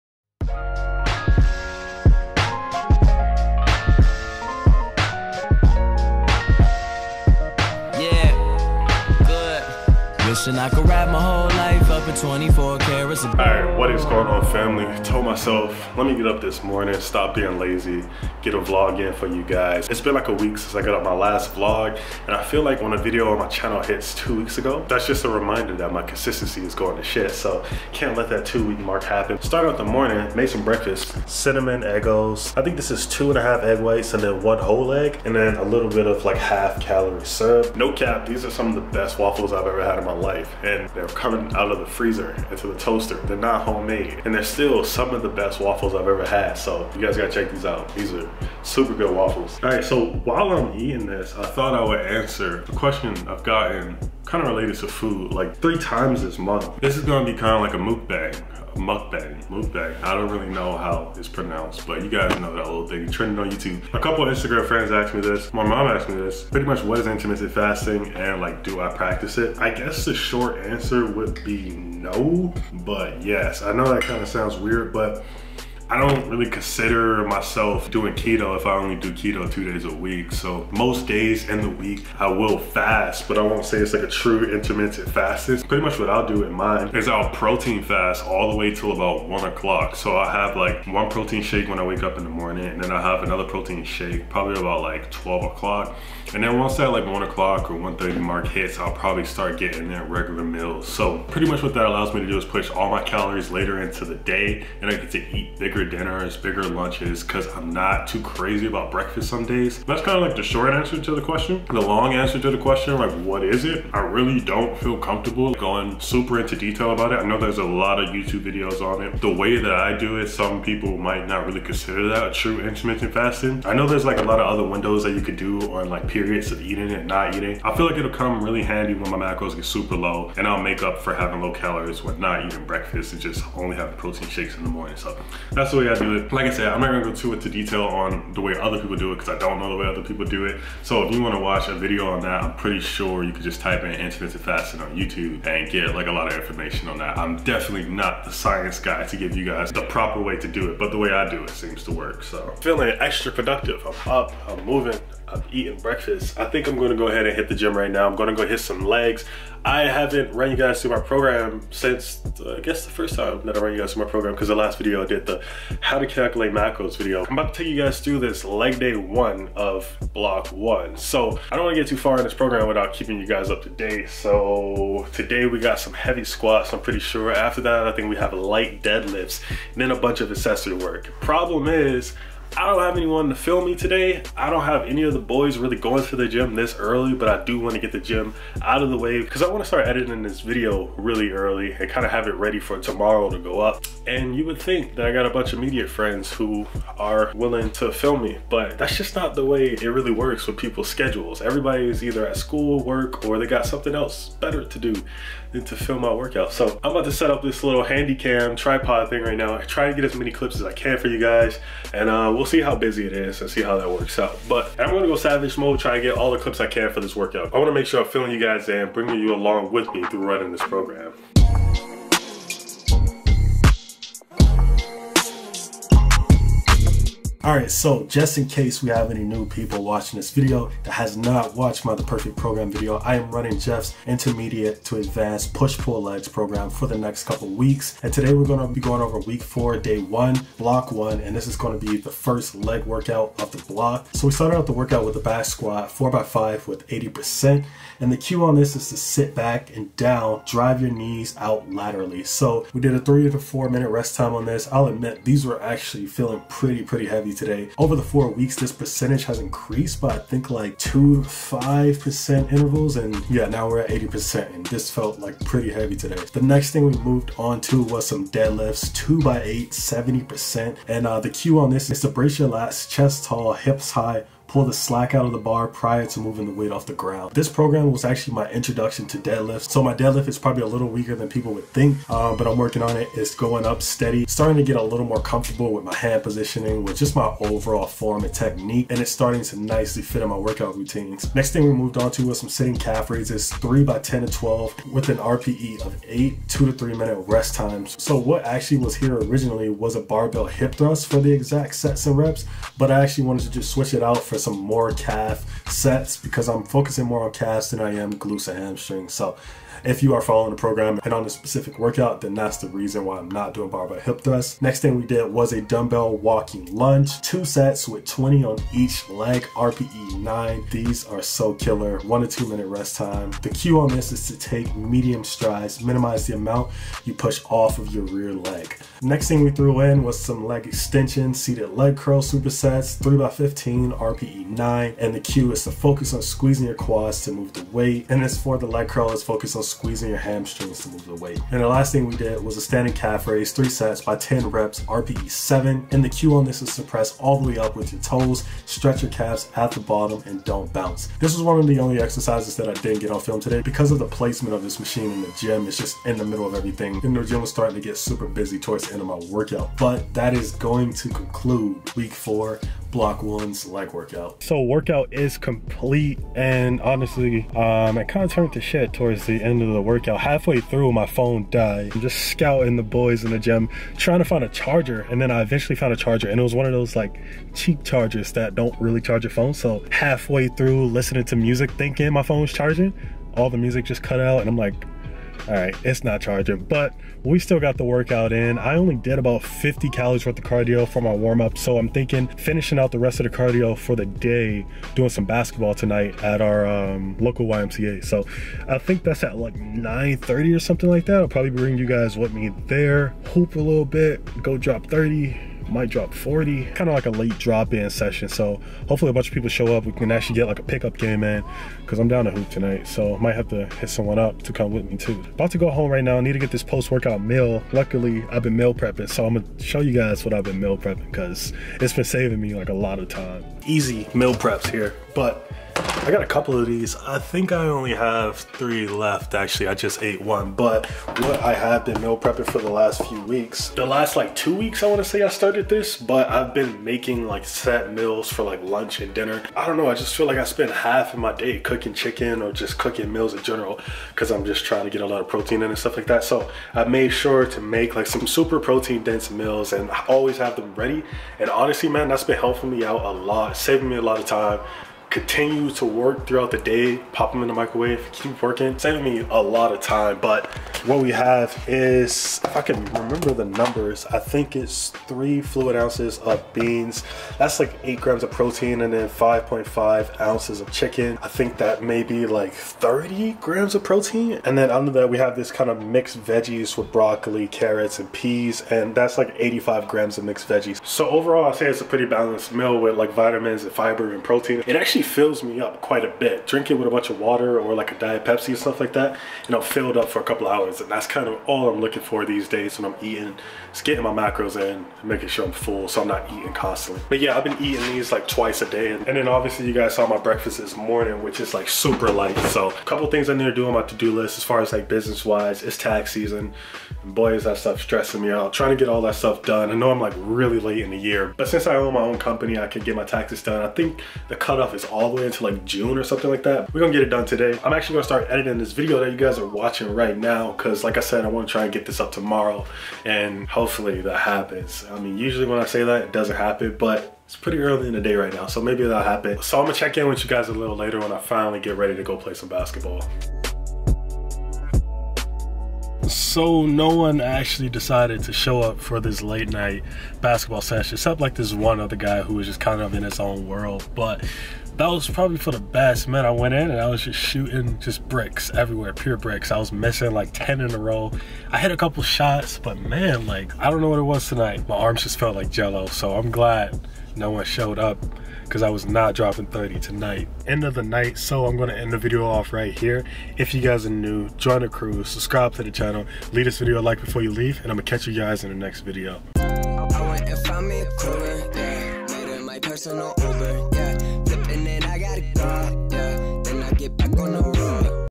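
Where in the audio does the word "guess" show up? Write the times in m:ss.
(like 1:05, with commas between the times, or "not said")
1:09, 2:42.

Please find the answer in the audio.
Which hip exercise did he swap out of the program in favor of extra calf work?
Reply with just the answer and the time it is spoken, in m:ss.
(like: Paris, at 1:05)
Barbell hip thrust, at 5:00.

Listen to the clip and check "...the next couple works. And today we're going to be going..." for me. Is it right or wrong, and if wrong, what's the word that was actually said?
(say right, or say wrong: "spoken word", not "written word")
wrong: "weeks", not "works".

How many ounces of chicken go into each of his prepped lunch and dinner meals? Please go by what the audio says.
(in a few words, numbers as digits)
5.5 ounces.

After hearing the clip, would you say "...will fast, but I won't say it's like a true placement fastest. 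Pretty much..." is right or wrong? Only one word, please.
wrong.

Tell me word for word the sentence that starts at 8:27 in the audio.
And boy, is that stuff stressing me out.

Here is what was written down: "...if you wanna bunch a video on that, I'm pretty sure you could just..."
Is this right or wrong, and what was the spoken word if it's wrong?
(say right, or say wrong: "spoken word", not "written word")
wrong: "watch", not "bunch".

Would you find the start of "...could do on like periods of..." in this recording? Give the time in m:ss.
2:05.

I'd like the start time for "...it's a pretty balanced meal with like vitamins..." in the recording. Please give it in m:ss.
8:01.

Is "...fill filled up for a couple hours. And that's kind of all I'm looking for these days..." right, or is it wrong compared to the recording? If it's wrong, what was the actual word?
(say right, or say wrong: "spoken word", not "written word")
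right.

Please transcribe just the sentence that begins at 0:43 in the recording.
They're not homemade and they're still some of the best waffles I've ever had.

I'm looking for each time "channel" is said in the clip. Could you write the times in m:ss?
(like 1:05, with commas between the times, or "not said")
0:23, 9:25.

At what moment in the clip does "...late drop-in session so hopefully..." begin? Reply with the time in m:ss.
6:47.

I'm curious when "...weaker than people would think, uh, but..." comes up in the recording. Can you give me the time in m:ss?
4:40.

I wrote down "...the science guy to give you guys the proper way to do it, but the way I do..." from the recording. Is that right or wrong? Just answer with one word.
right.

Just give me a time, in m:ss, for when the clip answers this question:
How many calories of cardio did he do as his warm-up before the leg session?
6:29.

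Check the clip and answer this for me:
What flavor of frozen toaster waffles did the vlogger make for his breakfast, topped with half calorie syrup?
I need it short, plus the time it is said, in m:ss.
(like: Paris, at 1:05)
Cinnamon, at 0:31.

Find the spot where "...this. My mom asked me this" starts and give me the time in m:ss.
1:05.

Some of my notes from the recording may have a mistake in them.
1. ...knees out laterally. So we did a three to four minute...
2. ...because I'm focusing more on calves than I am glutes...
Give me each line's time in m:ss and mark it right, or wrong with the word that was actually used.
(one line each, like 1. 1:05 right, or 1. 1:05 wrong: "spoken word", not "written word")
1. 4:10 right
2. 5:06 right.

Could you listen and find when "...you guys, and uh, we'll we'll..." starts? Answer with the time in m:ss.
3:31.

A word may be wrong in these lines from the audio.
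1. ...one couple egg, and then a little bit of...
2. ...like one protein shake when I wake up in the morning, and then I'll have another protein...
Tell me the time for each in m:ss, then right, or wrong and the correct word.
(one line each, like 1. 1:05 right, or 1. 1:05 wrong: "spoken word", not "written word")
1. 0:34 wrong: "whole", not "couple"
2. 1:30 right.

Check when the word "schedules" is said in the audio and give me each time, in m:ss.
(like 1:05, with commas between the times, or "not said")
3:20.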